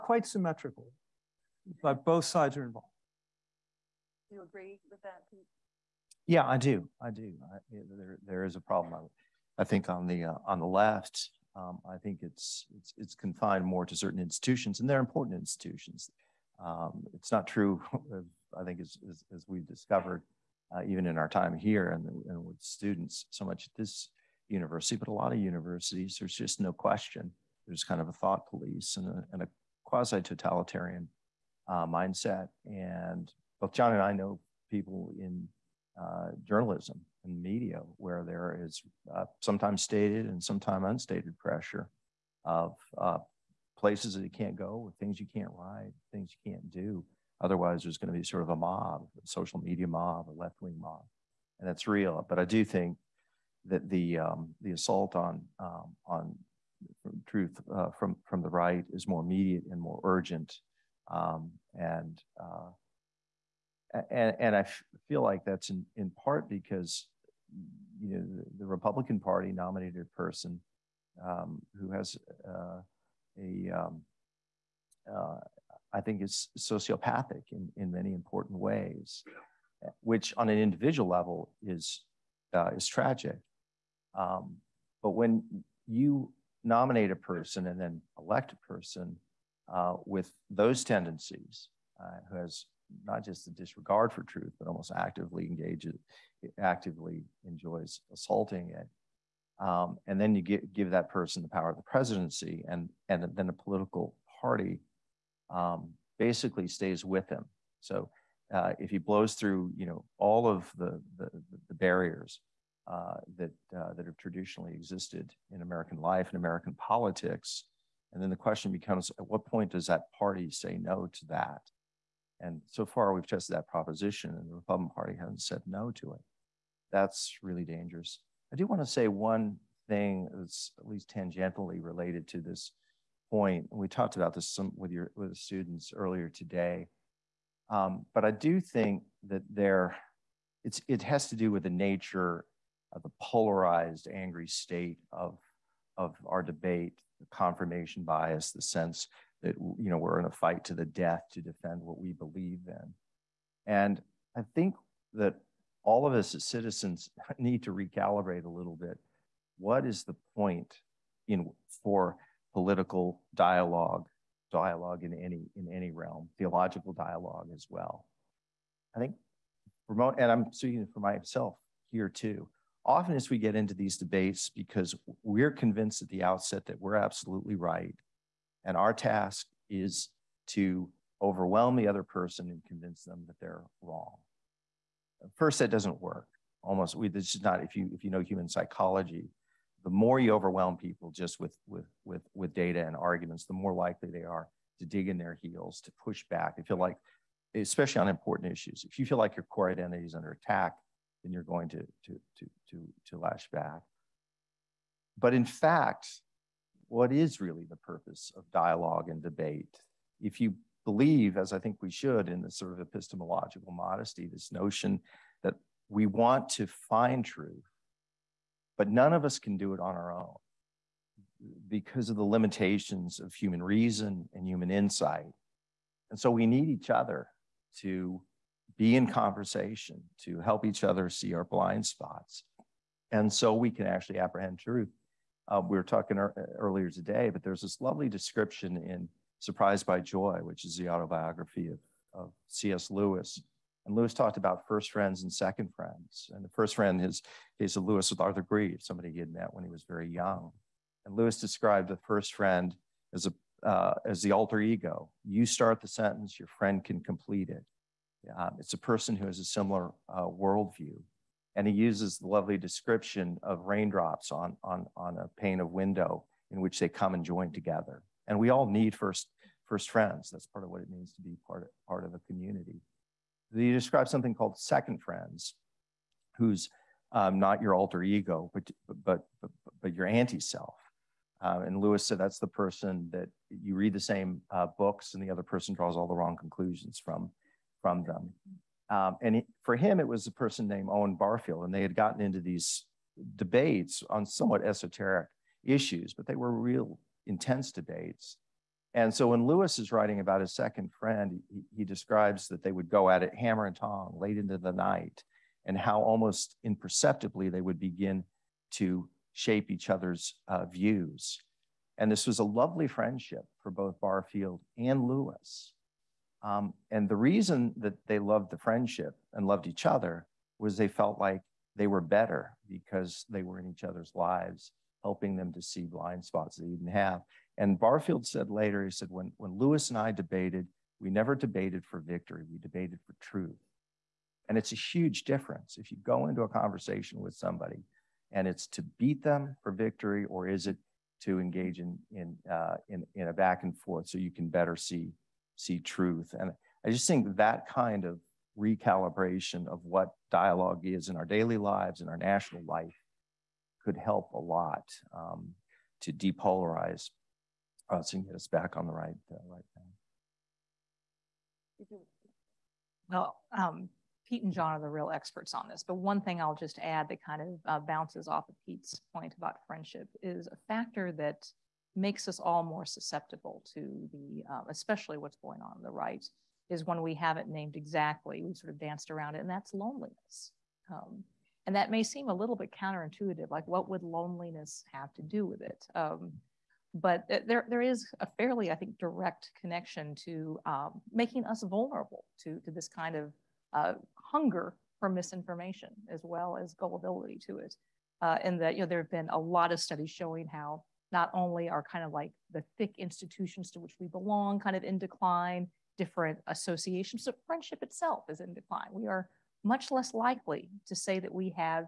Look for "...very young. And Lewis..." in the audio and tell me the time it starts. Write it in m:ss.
4:09.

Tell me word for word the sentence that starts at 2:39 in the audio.
What is the point in for political dialogue, dialogue in any in any realm, theological dialogue as well?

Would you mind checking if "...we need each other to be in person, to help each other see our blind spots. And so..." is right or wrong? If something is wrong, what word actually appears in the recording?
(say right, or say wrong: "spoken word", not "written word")
wrong: "conversation", not "person".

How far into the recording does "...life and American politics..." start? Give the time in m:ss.
1:56.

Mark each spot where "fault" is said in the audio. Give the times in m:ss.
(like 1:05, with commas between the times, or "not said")
not said.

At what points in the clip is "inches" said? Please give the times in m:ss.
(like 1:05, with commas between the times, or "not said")
not said.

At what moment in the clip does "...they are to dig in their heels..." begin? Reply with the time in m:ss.
3:14.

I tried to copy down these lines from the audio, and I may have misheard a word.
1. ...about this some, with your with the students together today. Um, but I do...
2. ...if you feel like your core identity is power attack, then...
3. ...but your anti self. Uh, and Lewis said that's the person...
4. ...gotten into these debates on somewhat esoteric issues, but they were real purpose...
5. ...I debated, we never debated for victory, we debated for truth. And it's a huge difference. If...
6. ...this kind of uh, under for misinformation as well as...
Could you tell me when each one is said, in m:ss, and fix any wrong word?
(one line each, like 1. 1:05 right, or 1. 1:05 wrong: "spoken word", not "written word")
1. 2:14 wrong: "earlier", not "together"
2. 3:18 wrong: "under", not "power"
3. 4:39 right
4. 4:51 wrong: "intense", not "purpose"
5. 5:29 right
6. 6:32 wrong: "hunger", not "under".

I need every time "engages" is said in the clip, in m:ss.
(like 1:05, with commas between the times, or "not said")
1:35, 5:41.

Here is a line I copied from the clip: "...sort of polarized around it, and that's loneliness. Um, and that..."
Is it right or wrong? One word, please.
wrong.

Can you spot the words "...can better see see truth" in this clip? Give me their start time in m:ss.
5:44.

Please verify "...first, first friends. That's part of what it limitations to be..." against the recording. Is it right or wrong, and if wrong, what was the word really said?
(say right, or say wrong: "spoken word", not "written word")
wrong: "means", not "limitations".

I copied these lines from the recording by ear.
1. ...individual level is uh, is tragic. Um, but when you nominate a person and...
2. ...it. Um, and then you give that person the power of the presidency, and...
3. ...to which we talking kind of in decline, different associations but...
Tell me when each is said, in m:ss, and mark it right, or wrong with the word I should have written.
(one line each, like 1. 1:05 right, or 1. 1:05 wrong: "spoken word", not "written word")
1. 1:20 right
2. 1:38 right
3. 6:43 wrong: "belong", not "talking".